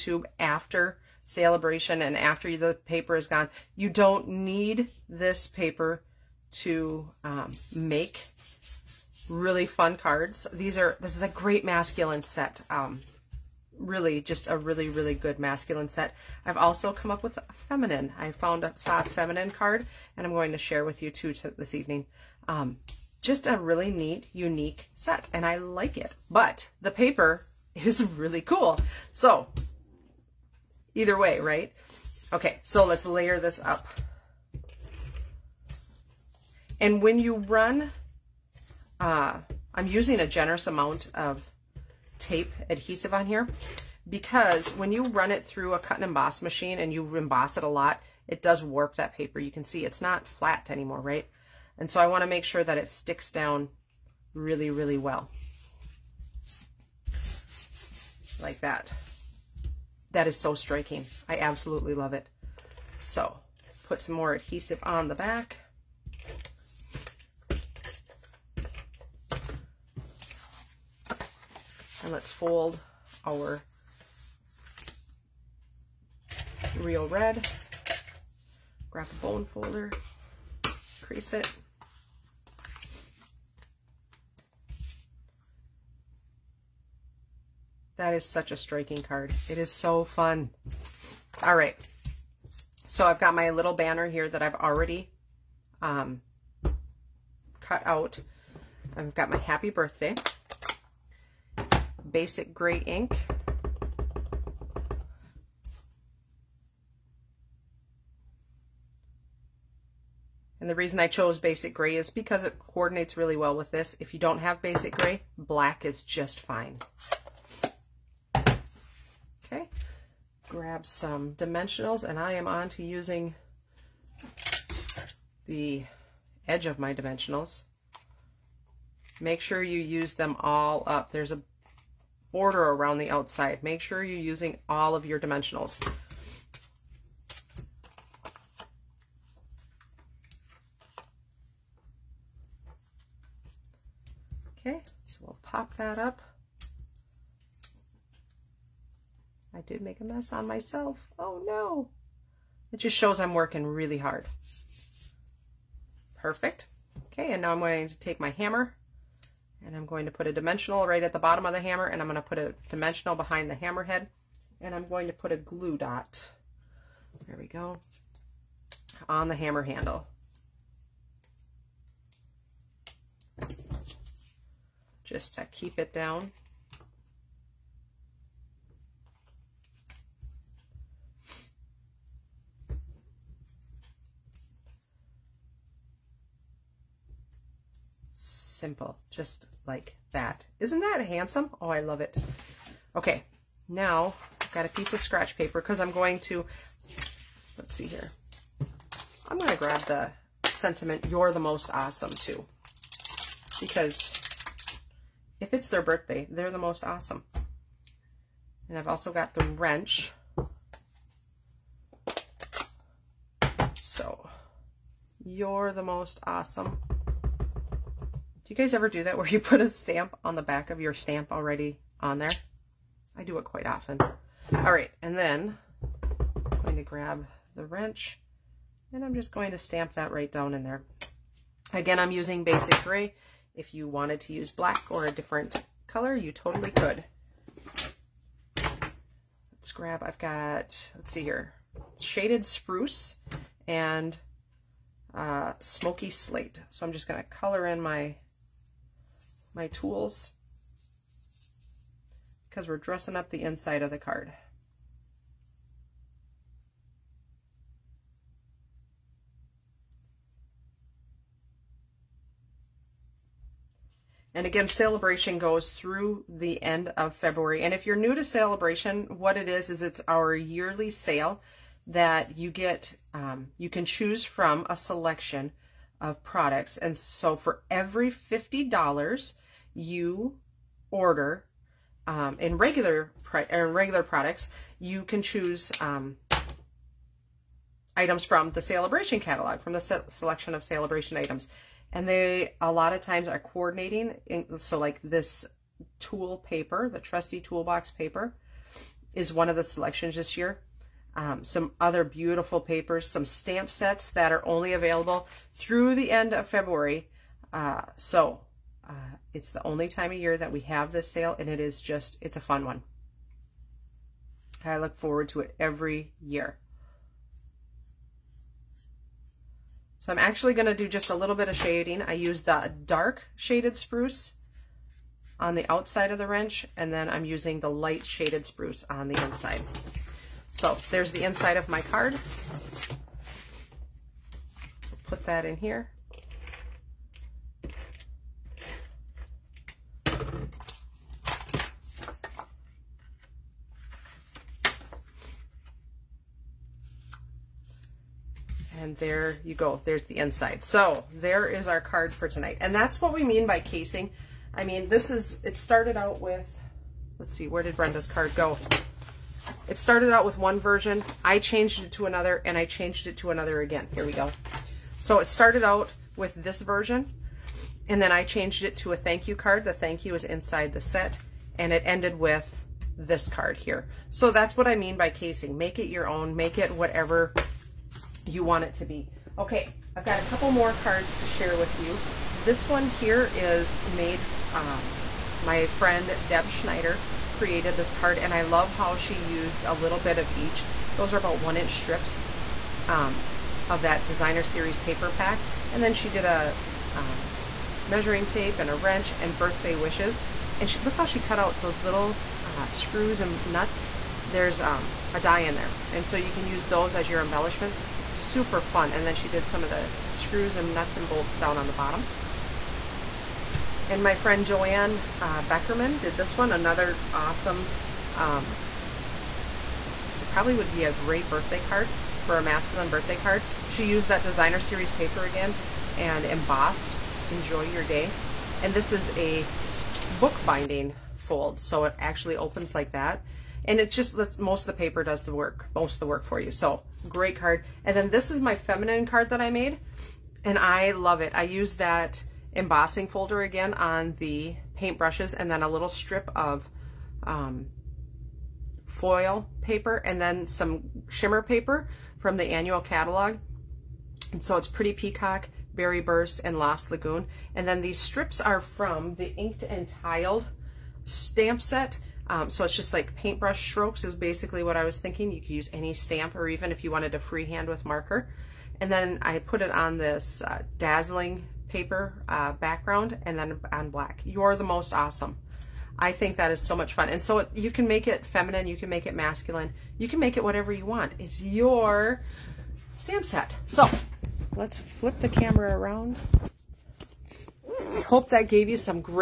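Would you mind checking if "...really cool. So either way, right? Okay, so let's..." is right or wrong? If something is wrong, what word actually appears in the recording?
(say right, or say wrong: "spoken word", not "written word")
right.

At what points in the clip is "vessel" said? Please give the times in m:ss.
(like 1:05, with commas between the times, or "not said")
not said.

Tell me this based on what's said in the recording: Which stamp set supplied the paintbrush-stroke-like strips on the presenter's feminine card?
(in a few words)
Inked and Tiled.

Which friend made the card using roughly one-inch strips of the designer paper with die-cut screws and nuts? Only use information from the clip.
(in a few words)
Deb Schneider.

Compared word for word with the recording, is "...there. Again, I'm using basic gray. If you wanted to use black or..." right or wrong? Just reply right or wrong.
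right.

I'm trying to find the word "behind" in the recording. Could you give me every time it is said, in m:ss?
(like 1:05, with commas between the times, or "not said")
2:43.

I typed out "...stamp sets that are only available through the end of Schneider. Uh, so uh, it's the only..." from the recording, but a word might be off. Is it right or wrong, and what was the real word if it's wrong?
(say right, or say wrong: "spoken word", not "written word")
wrong: "February", not "Schneider".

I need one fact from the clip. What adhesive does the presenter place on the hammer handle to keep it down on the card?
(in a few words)
Glue dot.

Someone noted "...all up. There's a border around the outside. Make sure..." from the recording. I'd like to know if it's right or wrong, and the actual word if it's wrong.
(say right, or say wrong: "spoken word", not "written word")
right.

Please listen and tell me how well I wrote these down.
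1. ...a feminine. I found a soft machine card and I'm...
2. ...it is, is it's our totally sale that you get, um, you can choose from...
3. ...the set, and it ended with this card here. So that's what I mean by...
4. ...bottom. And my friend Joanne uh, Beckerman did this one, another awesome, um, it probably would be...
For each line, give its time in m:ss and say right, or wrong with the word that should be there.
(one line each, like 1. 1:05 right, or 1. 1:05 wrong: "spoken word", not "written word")
1. 0:17 wrong: "feminine", not "machine"
2. 4:29 wrong: "yearly", not "totally"
3. 6:10 right
4. 6:51 right.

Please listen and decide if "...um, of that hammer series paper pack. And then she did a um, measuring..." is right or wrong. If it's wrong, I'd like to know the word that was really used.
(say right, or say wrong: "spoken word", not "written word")
wrong: "designer", not "hammer".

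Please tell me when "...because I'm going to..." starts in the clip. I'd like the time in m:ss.
3:15.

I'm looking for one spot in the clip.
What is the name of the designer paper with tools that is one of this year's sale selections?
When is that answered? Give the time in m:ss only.
4:56.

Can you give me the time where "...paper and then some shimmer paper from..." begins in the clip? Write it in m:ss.
7:29.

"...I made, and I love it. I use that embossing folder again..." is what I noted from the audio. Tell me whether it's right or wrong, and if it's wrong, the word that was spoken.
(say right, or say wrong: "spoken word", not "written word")
right.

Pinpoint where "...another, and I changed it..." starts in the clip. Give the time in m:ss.
6:02.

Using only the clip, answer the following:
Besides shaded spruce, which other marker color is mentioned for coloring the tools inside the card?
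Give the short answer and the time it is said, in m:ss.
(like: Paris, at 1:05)
Smoky Slate, at 4:05.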